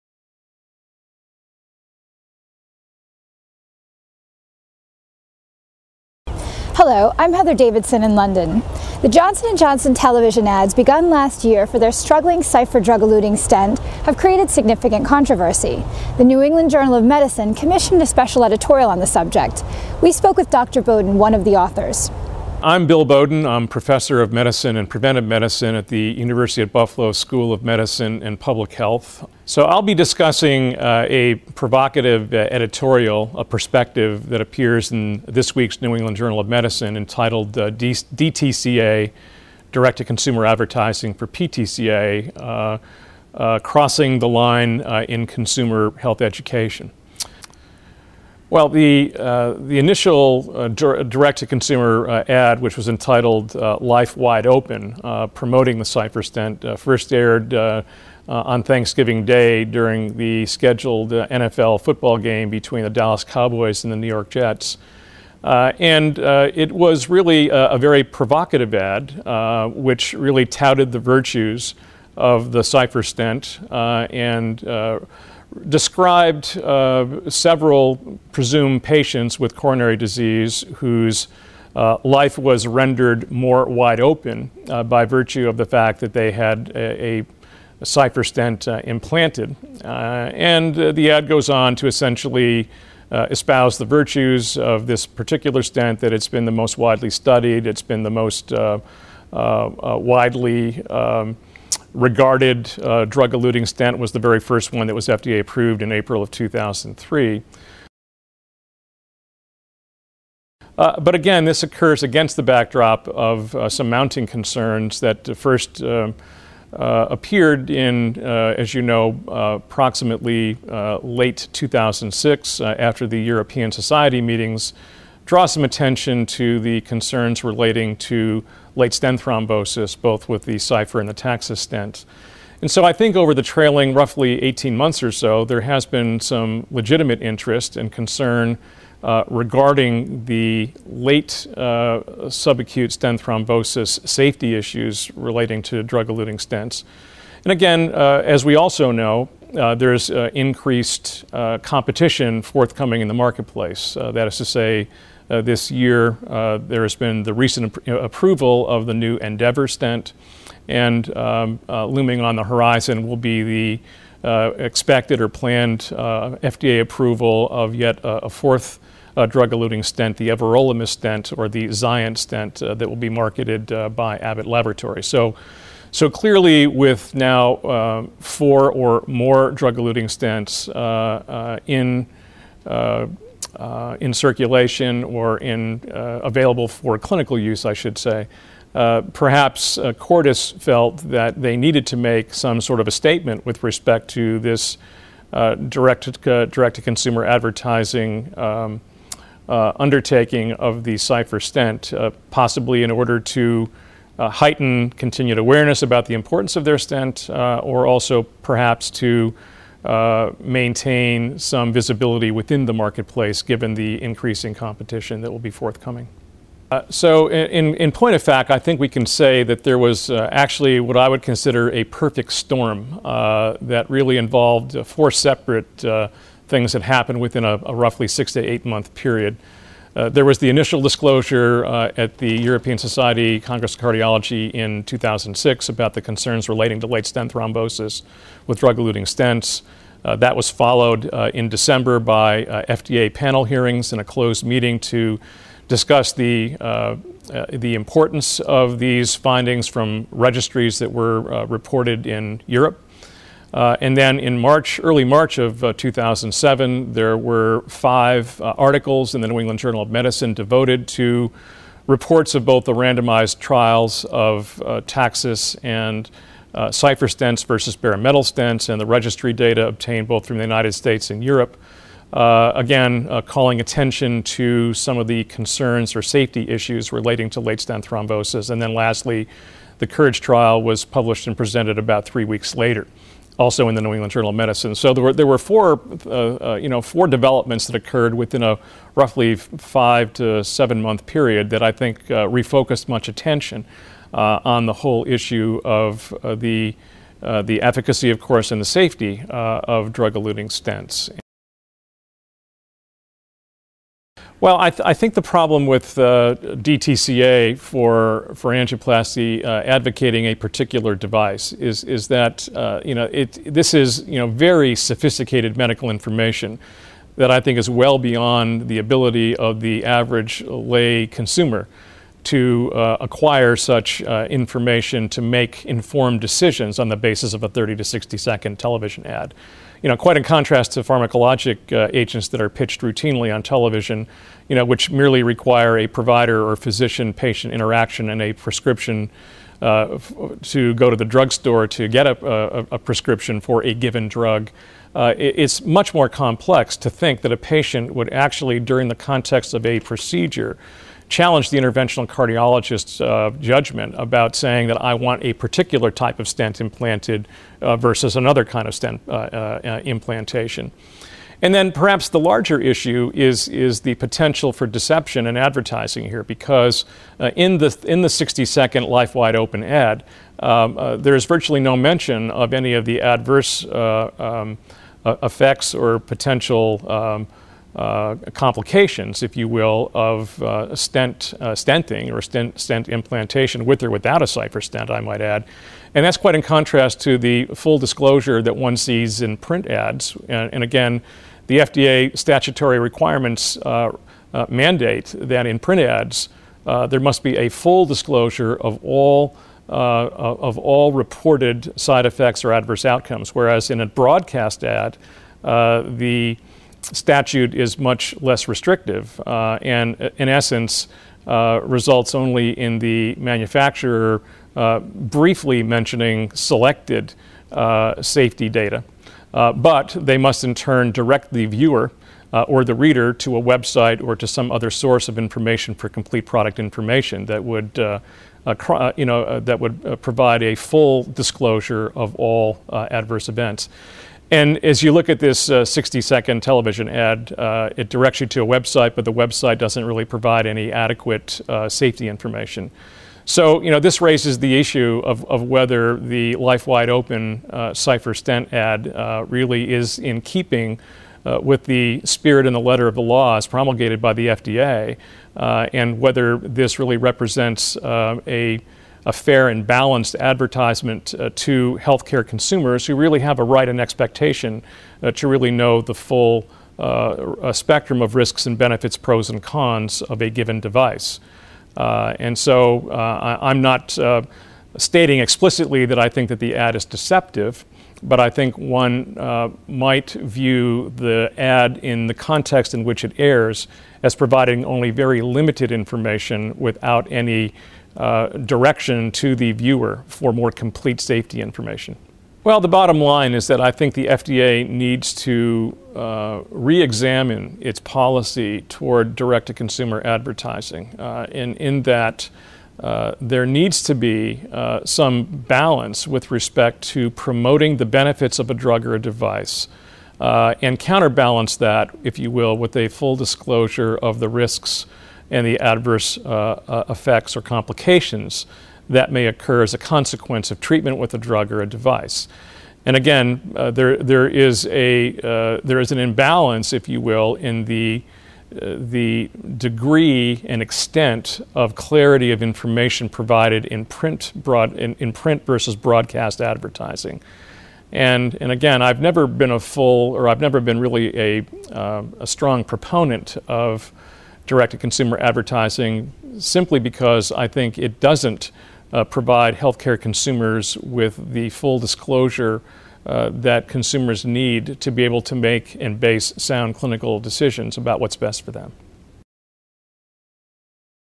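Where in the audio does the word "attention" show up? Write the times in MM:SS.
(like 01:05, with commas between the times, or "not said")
02:05, 04:33, 04:53.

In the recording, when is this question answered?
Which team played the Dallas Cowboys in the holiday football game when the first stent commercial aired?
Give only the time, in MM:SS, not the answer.
01:03.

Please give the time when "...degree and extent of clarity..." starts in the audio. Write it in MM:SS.
08:49.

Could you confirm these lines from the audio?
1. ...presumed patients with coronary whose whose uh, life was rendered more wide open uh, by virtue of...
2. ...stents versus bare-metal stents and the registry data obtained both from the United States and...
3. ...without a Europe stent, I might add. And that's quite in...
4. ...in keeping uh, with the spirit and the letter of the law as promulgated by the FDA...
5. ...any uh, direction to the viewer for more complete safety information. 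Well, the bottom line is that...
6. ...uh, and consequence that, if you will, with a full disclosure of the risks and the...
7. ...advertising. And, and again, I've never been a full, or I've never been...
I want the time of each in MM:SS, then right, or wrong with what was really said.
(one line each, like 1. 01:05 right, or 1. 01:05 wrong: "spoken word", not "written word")
1. 01:18 wrong: "disease", not "whose"
2. 04:27 right
3. 06:23 wrong: "Cypher", not "Europe"
4. 07:29 right
5. 08:07 right
6. 08:30 wrong: "counterbalance", not "consequence"
7. 08:56 right.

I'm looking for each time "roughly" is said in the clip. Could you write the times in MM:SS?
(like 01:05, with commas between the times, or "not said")
02:13, 03:47, 04:48.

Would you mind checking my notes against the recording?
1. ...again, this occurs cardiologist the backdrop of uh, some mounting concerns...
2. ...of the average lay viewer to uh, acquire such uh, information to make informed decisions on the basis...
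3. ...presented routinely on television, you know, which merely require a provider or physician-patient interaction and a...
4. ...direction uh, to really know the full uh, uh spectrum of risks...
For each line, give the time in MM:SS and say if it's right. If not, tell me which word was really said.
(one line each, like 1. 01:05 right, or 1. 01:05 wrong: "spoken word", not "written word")
1. 01:51 wrong: "against", not "cardiologist"
2. 05:19 wrong: "consumer", not "viewer"
3. 05:32 wrong: "pitched", not "presented"
4. 07:43 wrong: "expectation", not "direction".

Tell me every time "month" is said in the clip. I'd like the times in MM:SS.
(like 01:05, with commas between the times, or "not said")
02:14, 03:48, 04:50.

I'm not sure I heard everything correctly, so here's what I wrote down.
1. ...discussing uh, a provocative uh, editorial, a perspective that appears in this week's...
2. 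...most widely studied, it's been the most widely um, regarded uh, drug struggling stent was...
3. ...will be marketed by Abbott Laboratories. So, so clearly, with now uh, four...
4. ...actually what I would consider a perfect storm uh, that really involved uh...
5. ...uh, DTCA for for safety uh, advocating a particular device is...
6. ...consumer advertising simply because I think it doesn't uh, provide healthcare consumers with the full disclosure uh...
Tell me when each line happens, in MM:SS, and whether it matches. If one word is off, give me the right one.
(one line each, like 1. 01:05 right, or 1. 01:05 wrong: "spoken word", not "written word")
1. 00:29 right
2. 01:36 wrong: "eluting", not "struggling"
3. 02:52 right
4. 03:40 right
5. 05:05 wrong: "angioplasty", not "safety"
6. 09:04 right.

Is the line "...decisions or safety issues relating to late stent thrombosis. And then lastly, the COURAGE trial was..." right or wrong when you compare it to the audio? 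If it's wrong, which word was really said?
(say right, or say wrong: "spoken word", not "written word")
wrong: "concerns", not "decisions".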